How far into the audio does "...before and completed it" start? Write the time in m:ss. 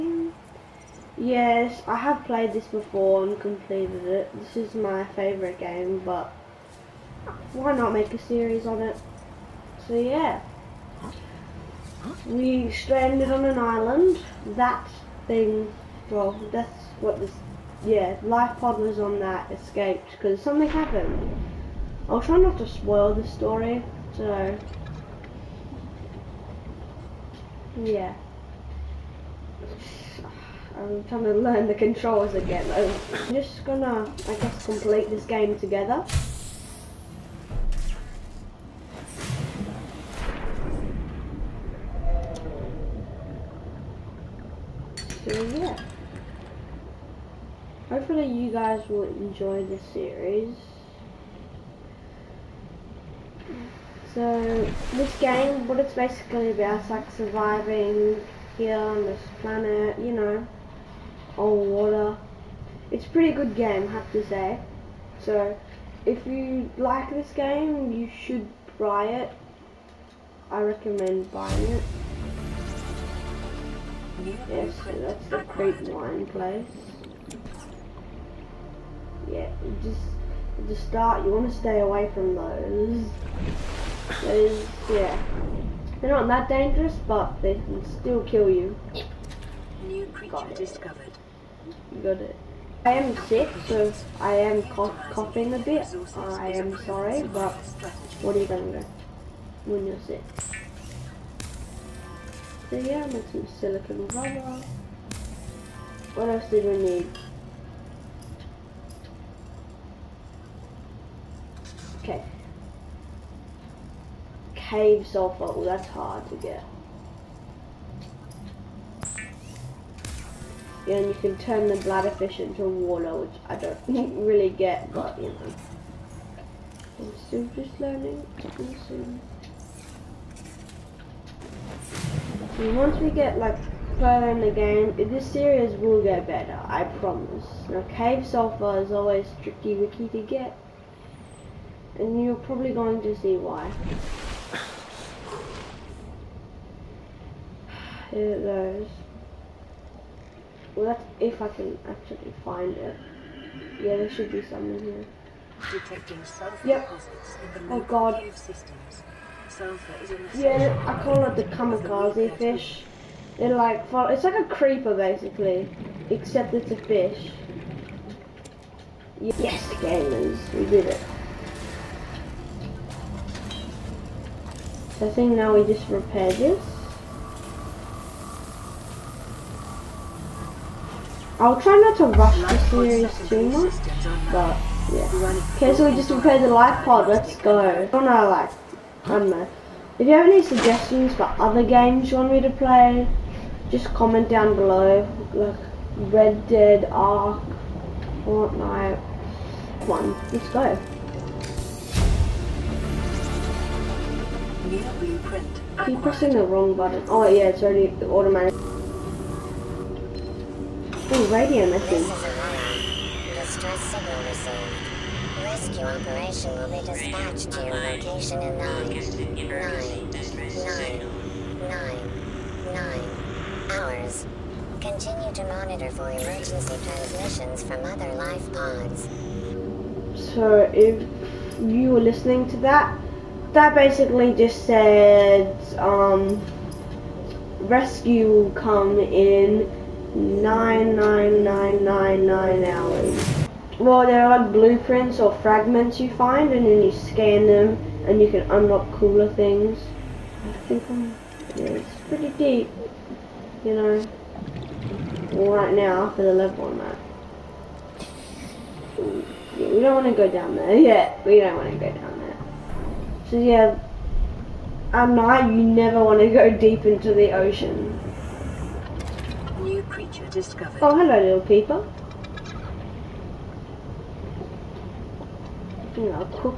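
0:02.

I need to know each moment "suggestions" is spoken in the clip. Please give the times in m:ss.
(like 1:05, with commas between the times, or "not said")
3:10.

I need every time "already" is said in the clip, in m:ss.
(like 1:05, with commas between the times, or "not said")
3:27.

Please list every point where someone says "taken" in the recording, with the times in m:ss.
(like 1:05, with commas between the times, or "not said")
not said.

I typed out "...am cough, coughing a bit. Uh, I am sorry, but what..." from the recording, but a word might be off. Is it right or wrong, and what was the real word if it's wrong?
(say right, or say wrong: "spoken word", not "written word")
right.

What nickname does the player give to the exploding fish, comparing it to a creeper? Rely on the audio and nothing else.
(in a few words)
kamikaze fish.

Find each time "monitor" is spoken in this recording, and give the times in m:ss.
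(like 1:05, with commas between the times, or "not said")
3:45.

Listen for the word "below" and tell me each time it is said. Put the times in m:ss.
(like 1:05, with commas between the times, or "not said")
3:14.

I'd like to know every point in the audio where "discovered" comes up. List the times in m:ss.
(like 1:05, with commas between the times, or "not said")
1:30, 4:30.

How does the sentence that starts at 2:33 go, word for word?
Yeah, there should be some in here.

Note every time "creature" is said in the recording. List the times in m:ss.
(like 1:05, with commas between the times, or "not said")
1:30, 4:29.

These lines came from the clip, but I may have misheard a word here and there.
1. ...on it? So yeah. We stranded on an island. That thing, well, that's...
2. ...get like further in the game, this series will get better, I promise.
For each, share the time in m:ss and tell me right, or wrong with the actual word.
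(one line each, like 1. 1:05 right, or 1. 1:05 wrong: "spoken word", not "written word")
1. 0:08 right
2. 2:13 right.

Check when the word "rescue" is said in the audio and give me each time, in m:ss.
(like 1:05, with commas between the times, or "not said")
3:35, 3:57.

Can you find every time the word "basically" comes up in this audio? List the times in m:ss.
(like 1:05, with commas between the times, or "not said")
0:55, 2:44, 3:53.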